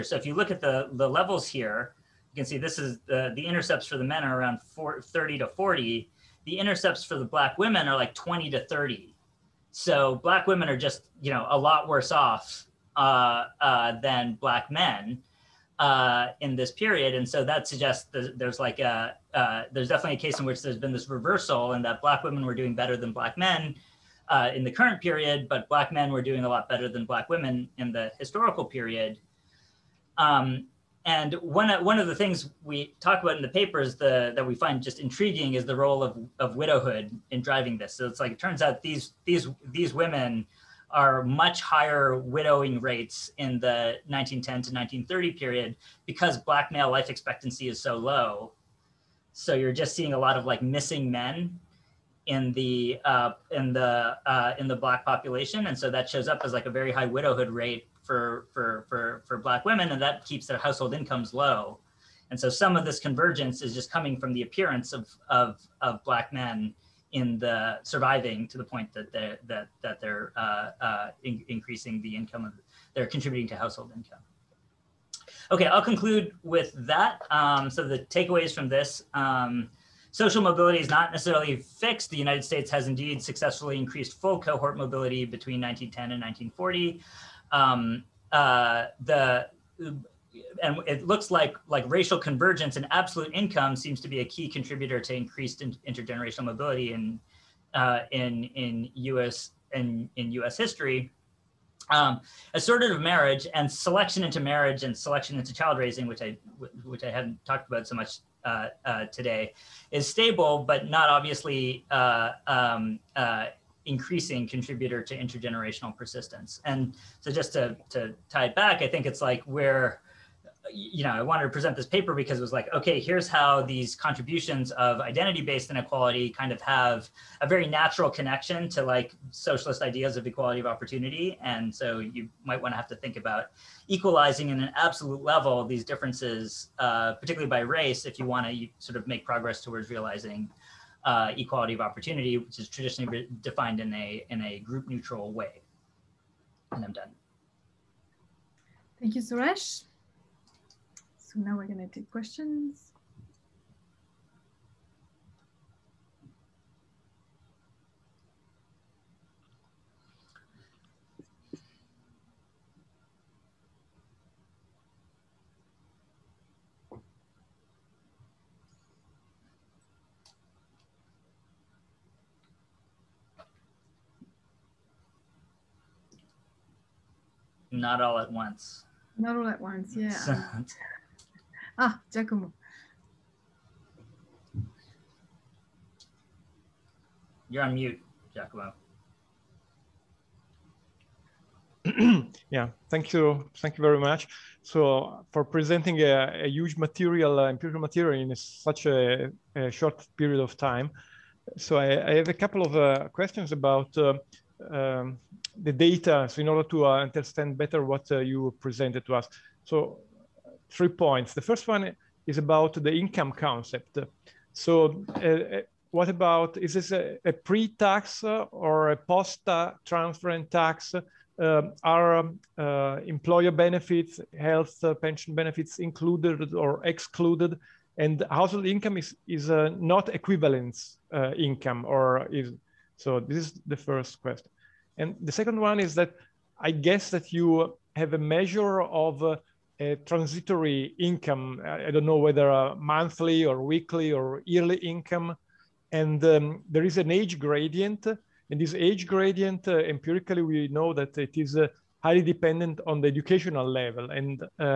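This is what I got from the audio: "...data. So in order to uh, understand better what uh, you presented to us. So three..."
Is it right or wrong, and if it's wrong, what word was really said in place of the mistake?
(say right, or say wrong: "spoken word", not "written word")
right.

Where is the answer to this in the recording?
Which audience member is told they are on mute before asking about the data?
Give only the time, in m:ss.
3:08.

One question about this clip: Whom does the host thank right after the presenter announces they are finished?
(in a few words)
Suresh.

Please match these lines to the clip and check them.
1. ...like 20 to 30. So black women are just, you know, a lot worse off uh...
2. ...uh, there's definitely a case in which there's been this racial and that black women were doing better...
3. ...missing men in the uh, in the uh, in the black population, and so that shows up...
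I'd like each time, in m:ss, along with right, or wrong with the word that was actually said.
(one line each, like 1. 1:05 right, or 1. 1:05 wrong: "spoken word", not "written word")
1. 0:07 right
2. 0:19 wrong: "reversal", not "racial"
3. 0:50 right.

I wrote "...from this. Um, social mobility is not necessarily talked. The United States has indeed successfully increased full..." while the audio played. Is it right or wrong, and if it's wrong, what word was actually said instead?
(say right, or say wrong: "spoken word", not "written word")
wrong: "fixed", not "talked".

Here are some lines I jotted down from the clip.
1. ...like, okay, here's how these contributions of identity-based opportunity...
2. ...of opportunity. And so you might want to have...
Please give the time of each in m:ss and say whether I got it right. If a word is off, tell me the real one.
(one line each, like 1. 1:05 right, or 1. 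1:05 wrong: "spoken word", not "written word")
1. 2:02 wrong: "inequality", not "opportunity"
2. 2:10 right.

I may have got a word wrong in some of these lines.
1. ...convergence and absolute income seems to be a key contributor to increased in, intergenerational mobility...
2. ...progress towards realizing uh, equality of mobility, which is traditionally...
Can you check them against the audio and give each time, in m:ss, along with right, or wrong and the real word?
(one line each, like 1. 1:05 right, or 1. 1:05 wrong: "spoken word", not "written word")
1. 1:32 right
2. 2:19 wrong: "opportunity", not "mobility".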